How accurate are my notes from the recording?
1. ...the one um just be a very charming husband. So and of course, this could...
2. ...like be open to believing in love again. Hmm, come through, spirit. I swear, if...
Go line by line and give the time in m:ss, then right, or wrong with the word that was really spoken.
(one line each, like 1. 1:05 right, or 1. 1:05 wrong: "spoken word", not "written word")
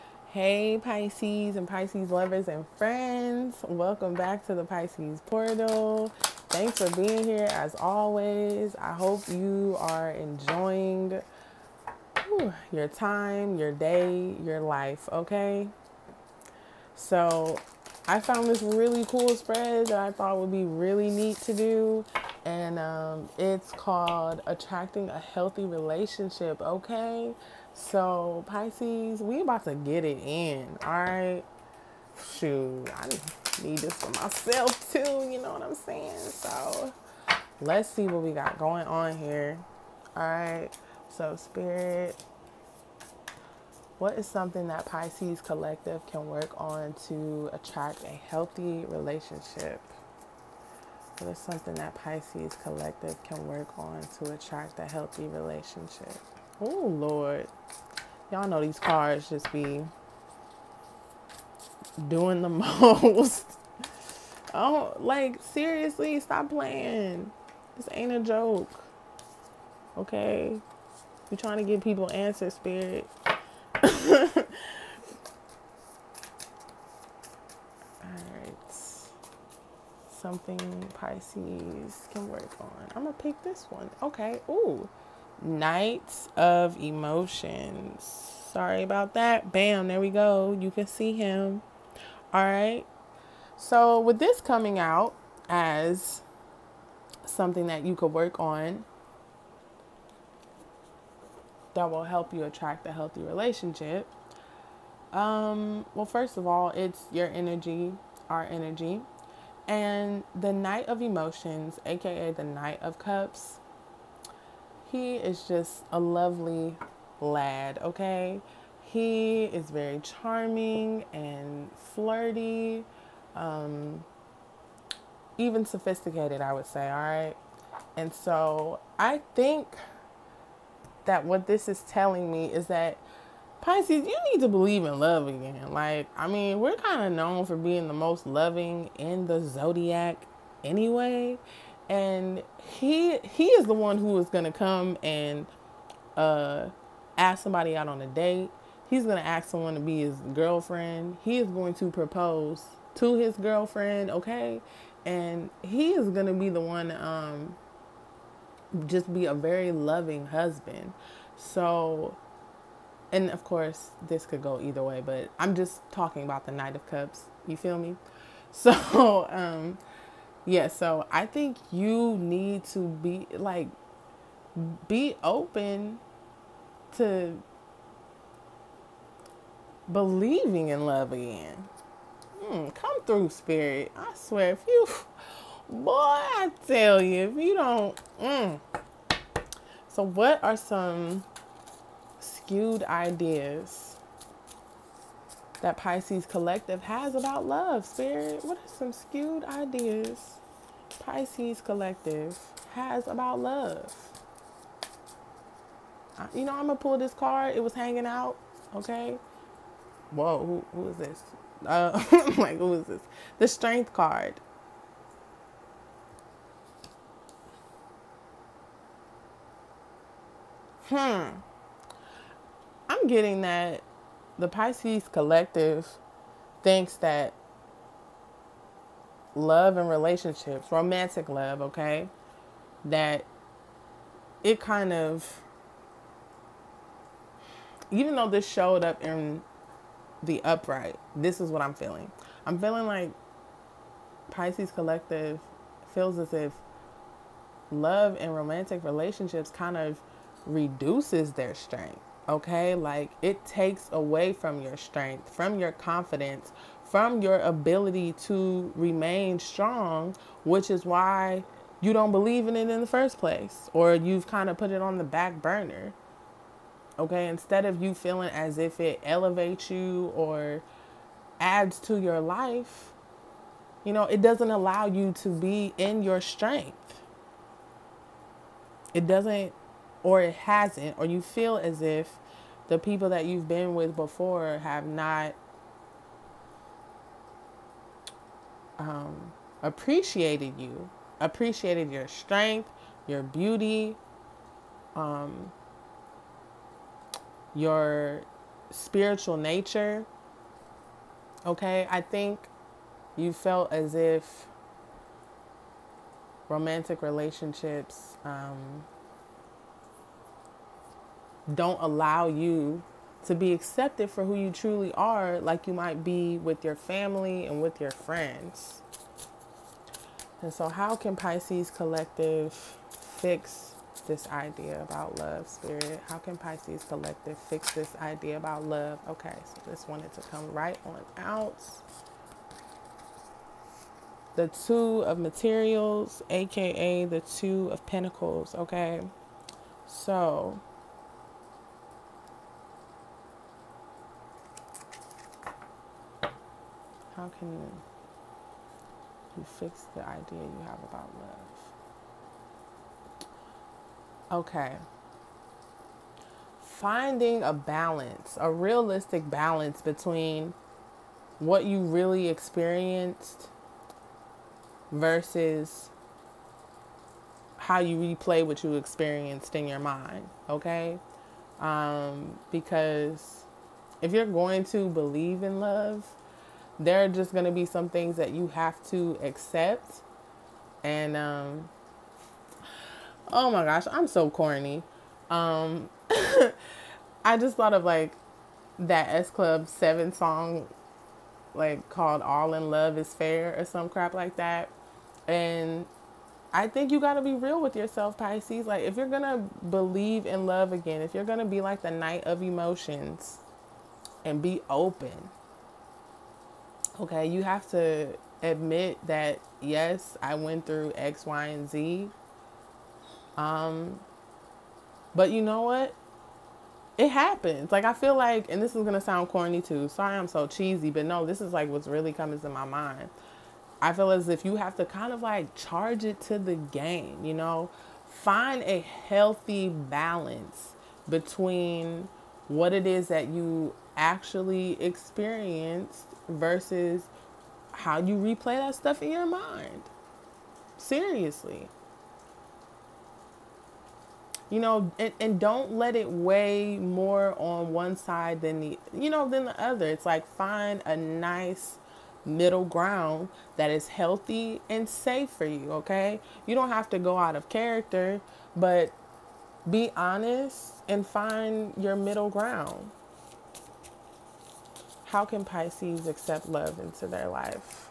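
1. 2:36 wrong: "loving", not "charming"
2. 2:53 right.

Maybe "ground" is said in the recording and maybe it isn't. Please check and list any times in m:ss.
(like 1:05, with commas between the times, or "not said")
7:32, 7:42.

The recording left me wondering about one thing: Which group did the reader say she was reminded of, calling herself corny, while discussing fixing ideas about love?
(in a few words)
S Club 7.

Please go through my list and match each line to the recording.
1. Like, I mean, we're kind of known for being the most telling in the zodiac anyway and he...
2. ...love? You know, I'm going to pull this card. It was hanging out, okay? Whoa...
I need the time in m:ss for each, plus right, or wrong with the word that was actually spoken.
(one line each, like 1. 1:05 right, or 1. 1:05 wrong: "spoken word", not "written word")
1. 2:15 wrong: "loving", not "telling"
2. 3:23 right.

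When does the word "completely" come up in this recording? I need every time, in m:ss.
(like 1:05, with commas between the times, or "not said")
not said.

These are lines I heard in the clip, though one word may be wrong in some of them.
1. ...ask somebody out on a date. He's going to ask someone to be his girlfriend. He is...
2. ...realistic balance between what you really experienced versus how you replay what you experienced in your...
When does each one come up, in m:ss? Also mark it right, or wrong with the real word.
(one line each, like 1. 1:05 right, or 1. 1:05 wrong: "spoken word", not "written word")
1. 2:27 right
2. 5:58 right.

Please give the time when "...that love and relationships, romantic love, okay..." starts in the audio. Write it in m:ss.
3:46.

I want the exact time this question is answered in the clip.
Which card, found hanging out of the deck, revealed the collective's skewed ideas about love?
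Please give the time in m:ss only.
3:33.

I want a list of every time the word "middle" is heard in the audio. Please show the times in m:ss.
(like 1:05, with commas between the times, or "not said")
7:32, 7:41.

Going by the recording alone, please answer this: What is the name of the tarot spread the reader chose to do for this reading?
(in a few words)
Attracting a Healthy Relationship.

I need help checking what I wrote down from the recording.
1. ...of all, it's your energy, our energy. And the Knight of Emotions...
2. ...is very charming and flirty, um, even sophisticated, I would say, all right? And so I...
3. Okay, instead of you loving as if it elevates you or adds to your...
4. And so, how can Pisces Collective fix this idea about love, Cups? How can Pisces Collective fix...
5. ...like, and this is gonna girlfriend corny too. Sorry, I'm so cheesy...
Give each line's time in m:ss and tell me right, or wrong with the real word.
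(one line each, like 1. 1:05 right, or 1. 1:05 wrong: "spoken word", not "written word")
1. 1:46 right
2. 1:59 right
3. 4:26 wrong: "feeling", not "loving"
4. 5:20 wrong: "Spirit", not "Cups"
5. 6:58 wrong: "sound", not "girlfriend".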